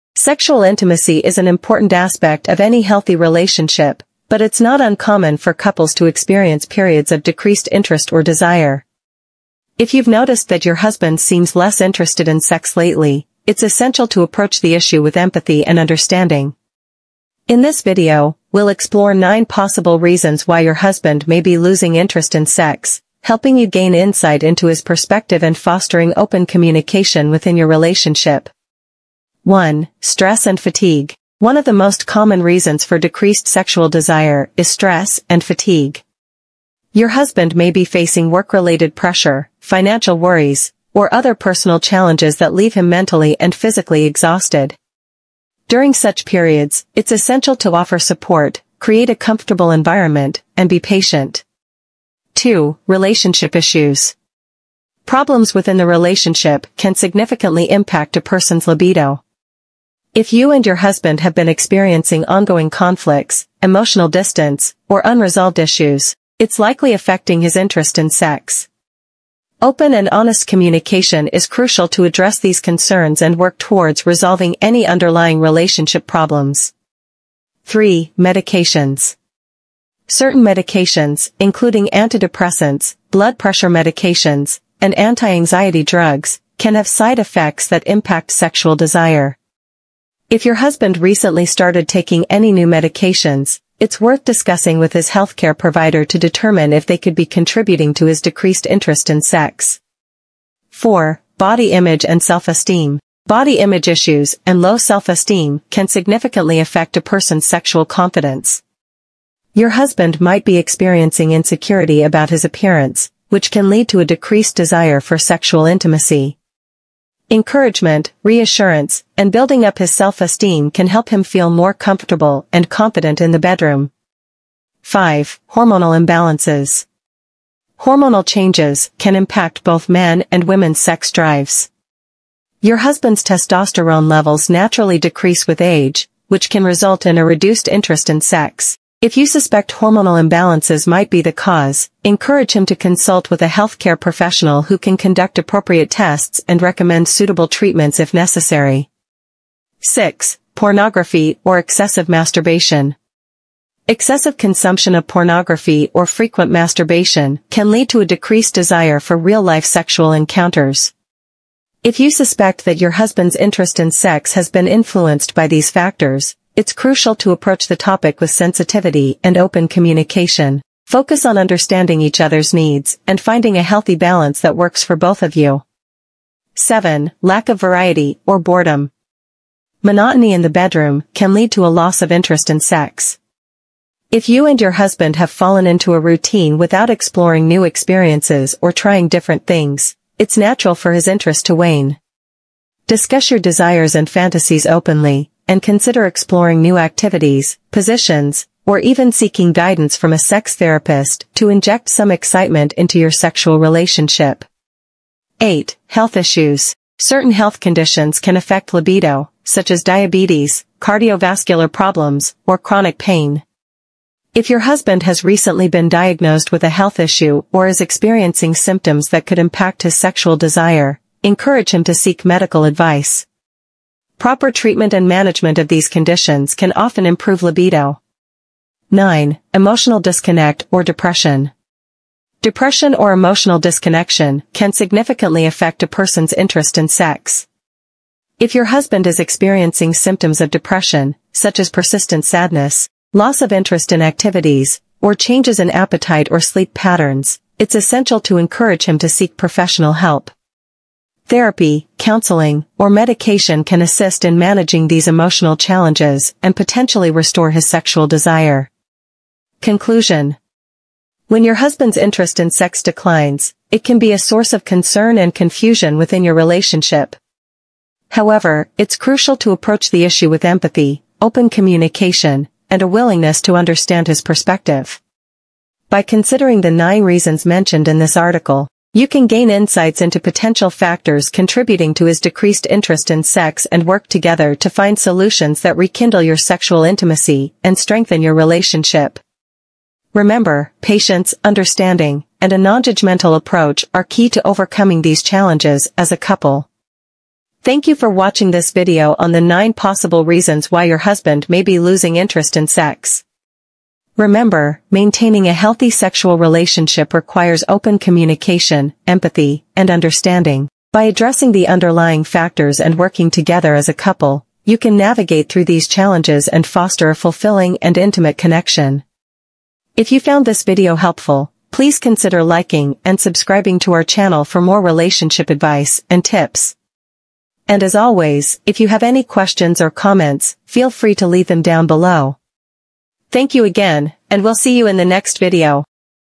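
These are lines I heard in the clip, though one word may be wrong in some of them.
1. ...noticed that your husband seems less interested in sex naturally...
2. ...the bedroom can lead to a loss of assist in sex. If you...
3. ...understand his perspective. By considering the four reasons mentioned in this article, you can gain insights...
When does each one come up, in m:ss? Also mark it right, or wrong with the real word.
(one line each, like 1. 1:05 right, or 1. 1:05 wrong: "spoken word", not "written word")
1. 0:10 wrong: "lately", not "naturally"
2. 3:00 wrong: "interest", not "assist"
3. 4:33 wrong: "nine", not "four".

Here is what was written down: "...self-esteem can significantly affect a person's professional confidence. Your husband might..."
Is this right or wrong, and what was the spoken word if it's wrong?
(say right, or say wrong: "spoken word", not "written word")
wrong: "sexual", not "professional".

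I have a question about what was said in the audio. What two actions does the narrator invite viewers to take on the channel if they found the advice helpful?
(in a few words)
liking and subscribing.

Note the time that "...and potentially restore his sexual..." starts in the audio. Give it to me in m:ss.
4:16.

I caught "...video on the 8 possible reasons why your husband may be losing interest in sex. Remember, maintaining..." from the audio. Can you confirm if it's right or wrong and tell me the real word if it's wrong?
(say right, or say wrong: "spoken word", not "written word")
wrong: "9", not "8".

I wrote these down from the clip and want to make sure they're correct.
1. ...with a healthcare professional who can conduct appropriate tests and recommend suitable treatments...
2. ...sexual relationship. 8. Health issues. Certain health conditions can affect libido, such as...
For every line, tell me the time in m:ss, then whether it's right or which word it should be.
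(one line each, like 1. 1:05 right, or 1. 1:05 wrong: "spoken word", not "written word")
1. 2:23 right
2. 3:23 right.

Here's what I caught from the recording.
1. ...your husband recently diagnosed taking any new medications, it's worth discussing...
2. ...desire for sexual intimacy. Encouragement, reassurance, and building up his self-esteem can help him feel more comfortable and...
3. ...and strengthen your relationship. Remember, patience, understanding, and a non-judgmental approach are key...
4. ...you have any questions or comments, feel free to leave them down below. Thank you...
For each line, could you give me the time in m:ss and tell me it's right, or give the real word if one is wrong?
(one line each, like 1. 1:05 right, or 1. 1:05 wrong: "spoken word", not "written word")
1. 1:30 wrong: "started", not "diagnosed"
2. 1:54 right
3. 4:47 right
4. 5:28 right.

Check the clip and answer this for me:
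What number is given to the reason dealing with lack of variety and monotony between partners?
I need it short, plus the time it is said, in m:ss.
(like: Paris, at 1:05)
7, at 2:56.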